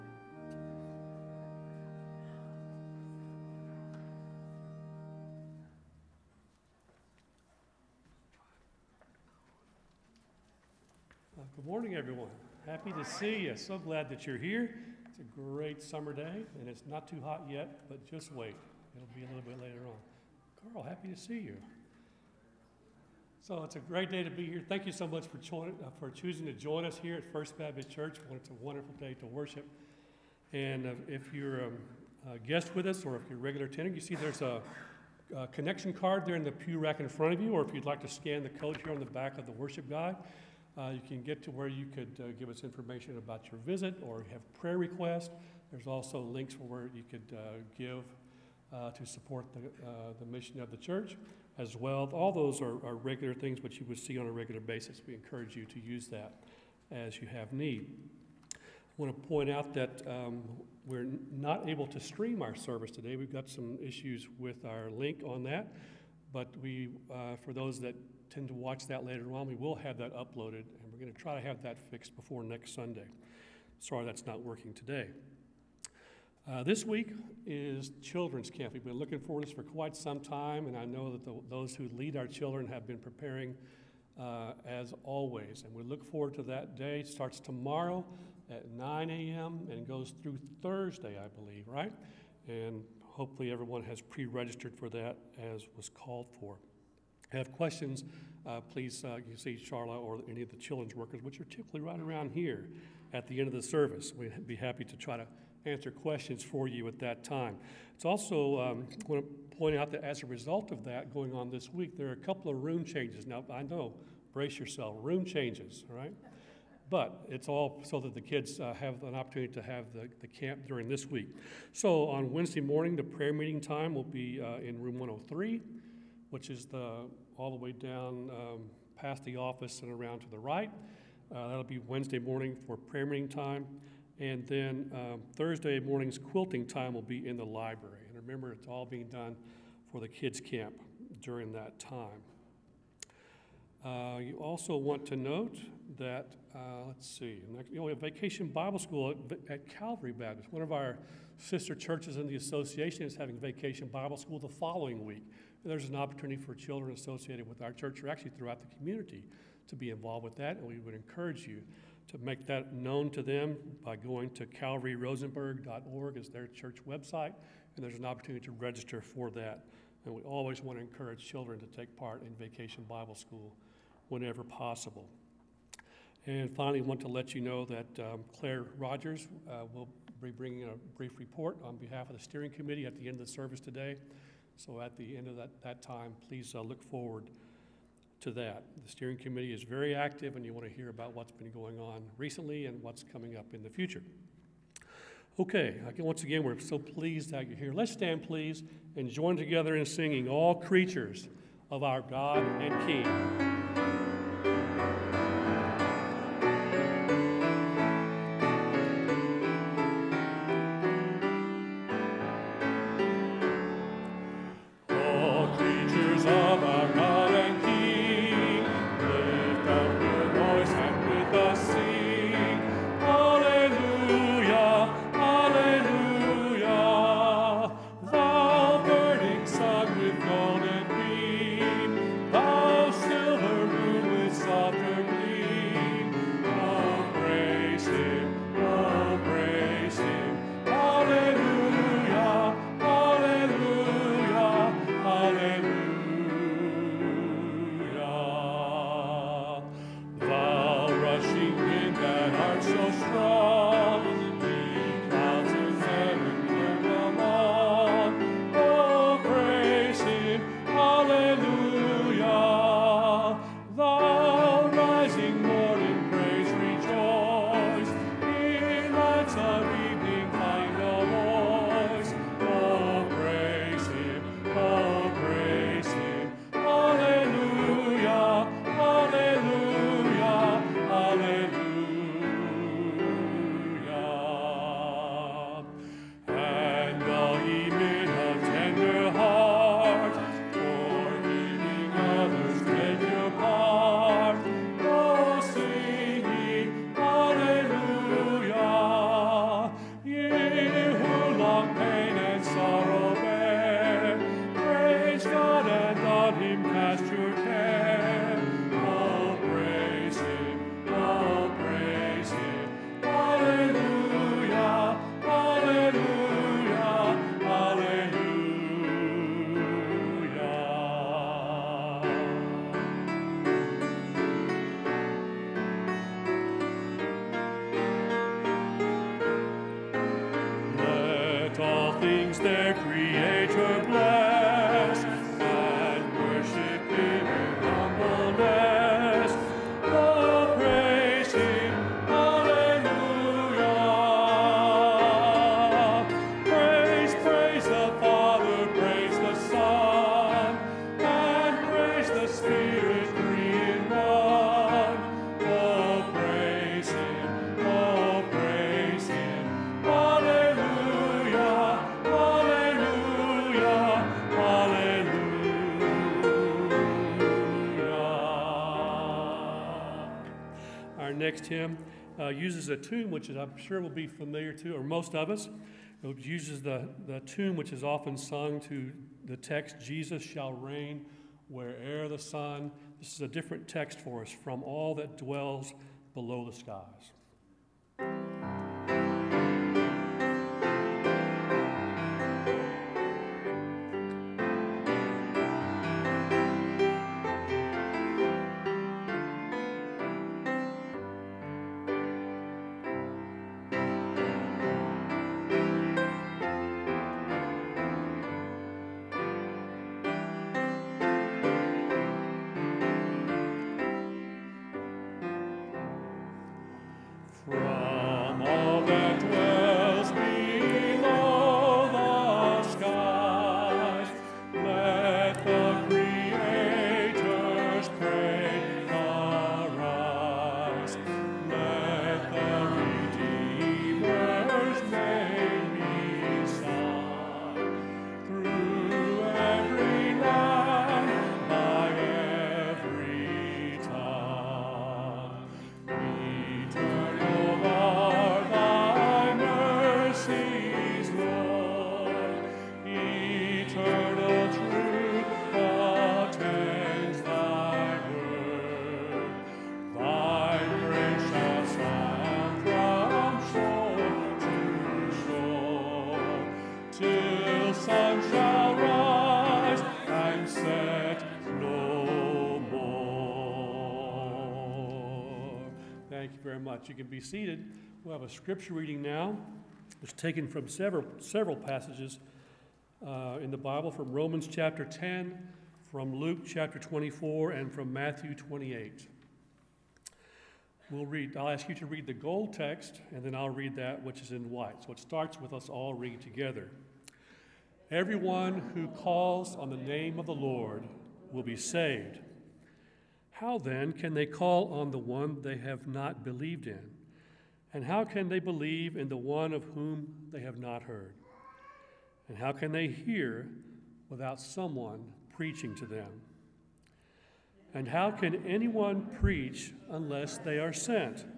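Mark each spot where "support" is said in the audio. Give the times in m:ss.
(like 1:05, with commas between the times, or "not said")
0:49.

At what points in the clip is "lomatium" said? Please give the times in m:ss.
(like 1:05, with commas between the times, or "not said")
not said.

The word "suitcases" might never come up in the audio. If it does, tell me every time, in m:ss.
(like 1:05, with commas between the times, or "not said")
not said.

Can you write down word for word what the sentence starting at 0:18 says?
It'll be a little bit later on.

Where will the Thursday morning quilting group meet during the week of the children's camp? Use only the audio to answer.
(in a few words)
The library.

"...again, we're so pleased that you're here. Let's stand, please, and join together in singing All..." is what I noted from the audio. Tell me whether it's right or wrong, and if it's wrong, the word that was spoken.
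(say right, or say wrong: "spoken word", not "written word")
right.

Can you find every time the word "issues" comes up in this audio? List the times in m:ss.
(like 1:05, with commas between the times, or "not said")
1:03.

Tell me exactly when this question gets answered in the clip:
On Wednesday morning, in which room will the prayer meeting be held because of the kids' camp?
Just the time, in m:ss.
2:04.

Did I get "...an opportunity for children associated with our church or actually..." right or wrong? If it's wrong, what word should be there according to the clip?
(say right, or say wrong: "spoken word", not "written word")
right.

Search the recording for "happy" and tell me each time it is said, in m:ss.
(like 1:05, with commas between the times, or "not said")
0:12, 0:20, 1:44.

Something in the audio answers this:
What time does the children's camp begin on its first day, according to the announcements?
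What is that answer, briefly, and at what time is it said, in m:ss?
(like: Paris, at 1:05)
9 a.m., at 1:28.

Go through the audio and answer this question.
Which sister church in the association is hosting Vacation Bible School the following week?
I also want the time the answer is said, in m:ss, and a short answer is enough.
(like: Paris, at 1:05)
Calvary Baptist, at 2:29.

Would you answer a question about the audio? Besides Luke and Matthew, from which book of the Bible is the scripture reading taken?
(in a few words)
Romans.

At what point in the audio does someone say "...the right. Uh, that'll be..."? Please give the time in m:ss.
2:10.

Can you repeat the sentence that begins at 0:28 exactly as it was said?
It's a wonderful day to worship.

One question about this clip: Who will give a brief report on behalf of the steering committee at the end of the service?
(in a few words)
Claire Rogers.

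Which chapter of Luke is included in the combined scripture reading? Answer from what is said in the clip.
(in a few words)
24.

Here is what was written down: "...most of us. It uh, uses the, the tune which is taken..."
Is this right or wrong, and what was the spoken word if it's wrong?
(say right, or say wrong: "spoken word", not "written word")
wrong: "often", not "taken".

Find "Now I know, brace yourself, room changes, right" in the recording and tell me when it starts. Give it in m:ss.
1:53.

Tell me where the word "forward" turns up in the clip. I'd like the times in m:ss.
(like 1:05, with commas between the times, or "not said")
1:26, 3:06.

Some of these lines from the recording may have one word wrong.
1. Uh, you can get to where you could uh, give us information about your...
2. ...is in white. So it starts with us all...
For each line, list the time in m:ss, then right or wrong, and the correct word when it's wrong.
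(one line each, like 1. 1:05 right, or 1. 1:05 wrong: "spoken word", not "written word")
1. 0:40 right
2. 8:14 right.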